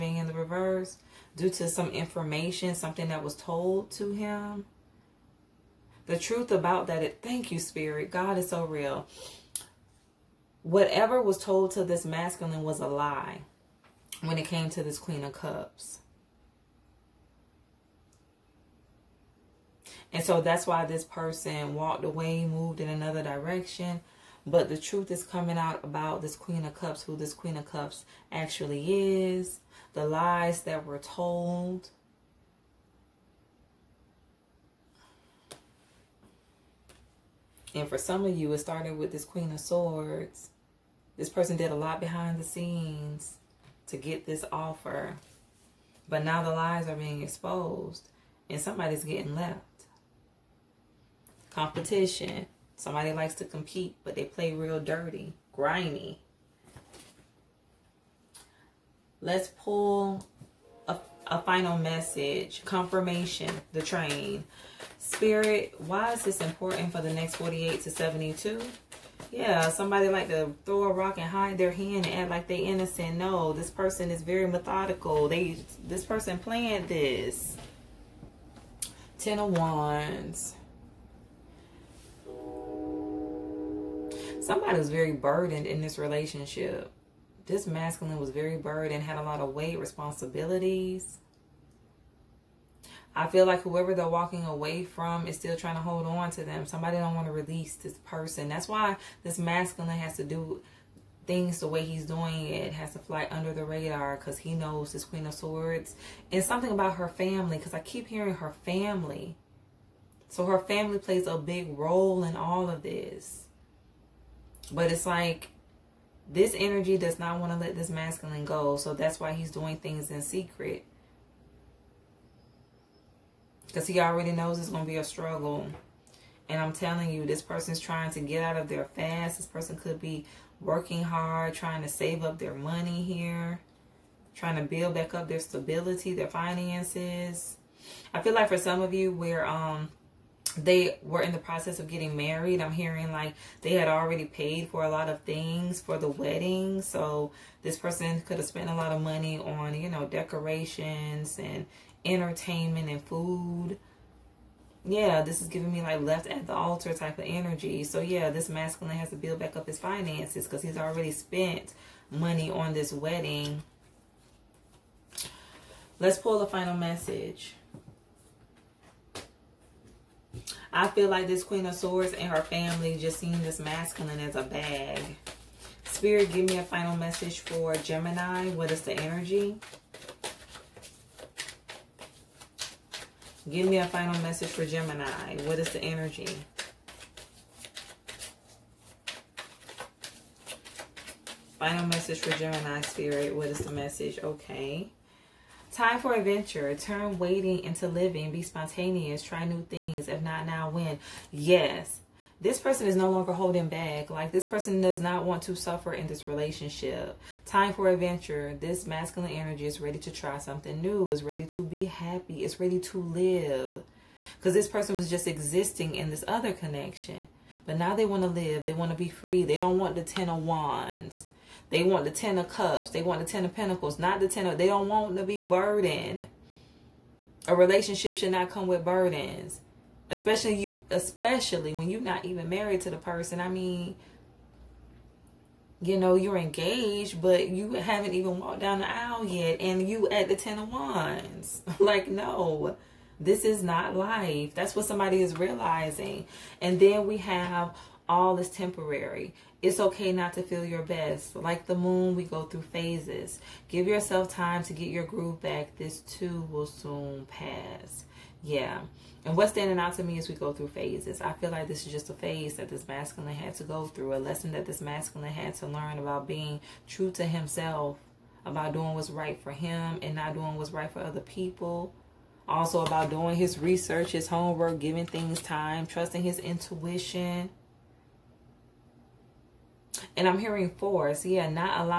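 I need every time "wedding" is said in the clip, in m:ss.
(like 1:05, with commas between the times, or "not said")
2:26, 2:42.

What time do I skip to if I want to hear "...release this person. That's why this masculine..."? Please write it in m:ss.
1:37.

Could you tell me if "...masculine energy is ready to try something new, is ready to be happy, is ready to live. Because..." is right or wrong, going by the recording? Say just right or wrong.
right.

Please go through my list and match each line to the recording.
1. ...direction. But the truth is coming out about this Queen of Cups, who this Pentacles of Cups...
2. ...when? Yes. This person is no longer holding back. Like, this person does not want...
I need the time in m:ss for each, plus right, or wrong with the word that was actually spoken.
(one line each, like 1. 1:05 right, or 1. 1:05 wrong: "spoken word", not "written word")
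1. 0:23 wrong: "Queen", not "Pentacles"
2. 3:20 right.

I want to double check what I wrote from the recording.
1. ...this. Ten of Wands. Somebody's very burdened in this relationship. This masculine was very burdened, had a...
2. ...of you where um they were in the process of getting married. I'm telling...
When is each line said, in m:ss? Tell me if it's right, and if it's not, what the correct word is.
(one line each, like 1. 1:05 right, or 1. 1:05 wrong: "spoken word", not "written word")
1. 1:16 right
2. 2:18 wrong: "hearing", not "telling".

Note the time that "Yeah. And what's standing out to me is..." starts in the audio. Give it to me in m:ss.
4:18.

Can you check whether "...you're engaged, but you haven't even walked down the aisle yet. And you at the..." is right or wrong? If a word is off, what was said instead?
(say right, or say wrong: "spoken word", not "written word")
right.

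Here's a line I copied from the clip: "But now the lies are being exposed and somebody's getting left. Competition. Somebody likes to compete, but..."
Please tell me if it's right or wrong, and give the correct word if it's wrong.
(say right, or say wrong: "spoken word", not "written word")
right.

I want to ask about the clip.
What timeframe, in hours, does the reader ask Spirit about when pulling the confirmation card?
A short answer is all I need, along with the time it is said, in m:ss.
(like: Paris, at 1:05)
48 to 72, at 1:07.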